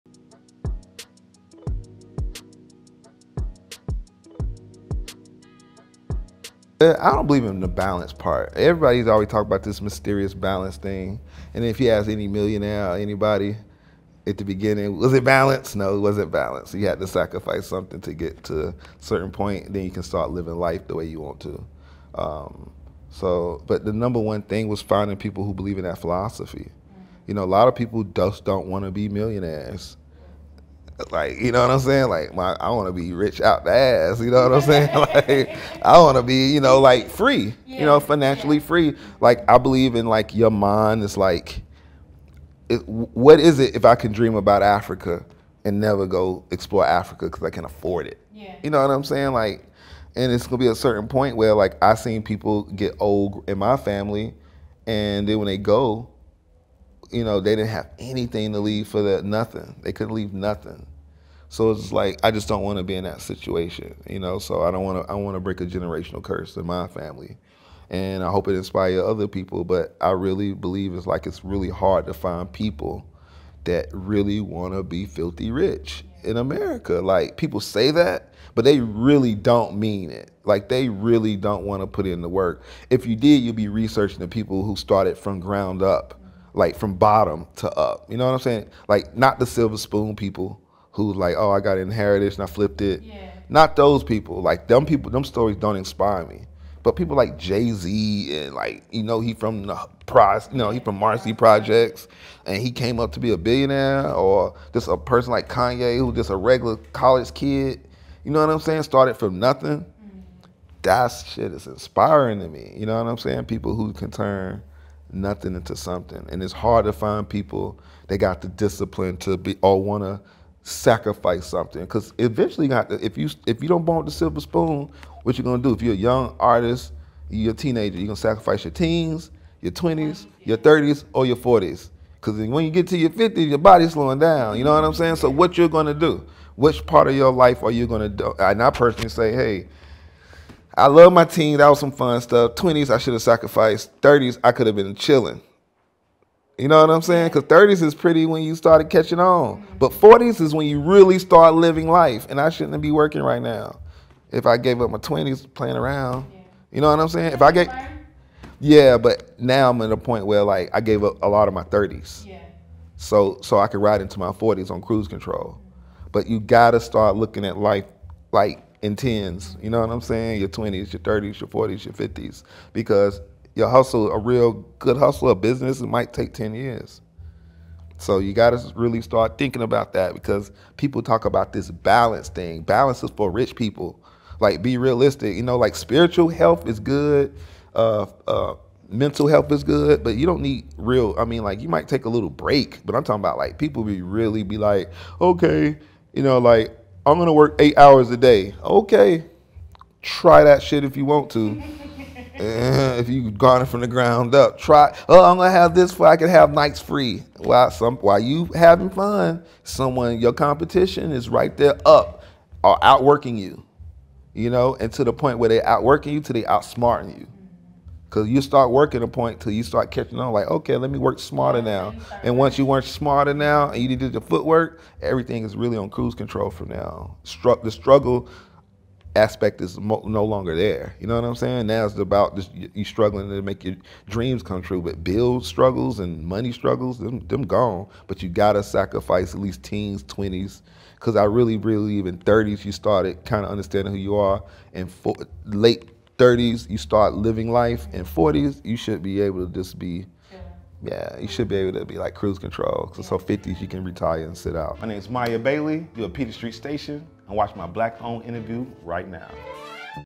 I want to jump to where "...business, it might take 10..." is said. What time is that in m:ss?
2:55.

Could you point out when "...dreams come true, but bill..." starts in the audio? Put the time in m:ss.
3:54.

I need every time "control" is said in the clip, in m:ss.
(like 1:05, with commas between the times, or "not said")
2:45, 3:46, 4:12.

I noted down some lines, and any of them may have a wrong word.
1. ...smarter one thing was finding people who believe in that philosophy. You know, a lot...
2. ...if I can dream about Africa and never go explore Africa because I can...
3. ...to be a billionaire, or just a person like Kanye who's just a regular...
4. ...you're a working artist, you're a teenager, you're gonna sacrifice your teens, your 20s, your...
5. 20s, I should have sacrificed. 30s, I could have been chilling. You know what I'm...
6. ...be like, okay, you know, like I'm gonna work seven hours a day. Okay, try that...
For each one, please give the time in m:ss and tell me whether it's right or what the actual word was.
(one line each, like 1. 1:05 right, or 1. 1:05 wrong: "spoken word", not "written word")
1. 0:23 wrong: "number", not "smarter"
2. 0:43 right
3. 1:43 right
4. 2:05 wrong: "young", not "working"
5. 2:22 right
6. 3:14 wrong: "eight", not "seven".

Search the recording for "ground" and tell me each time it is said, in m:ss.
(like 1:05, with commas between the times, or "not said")
1:25, 3:23.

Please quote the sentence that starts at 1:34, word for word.
Like them people, them stories don't inspire me.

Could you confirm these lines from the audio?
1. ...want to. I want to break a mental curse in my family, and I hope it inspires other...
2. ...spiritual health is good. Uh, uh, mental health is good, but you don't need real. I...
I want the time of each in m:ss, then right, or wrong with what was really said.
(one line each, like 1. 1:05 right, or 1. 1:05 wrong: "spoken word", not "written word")
1. 1:04 wrong: "generational", not "mental"
2. 3:05 right.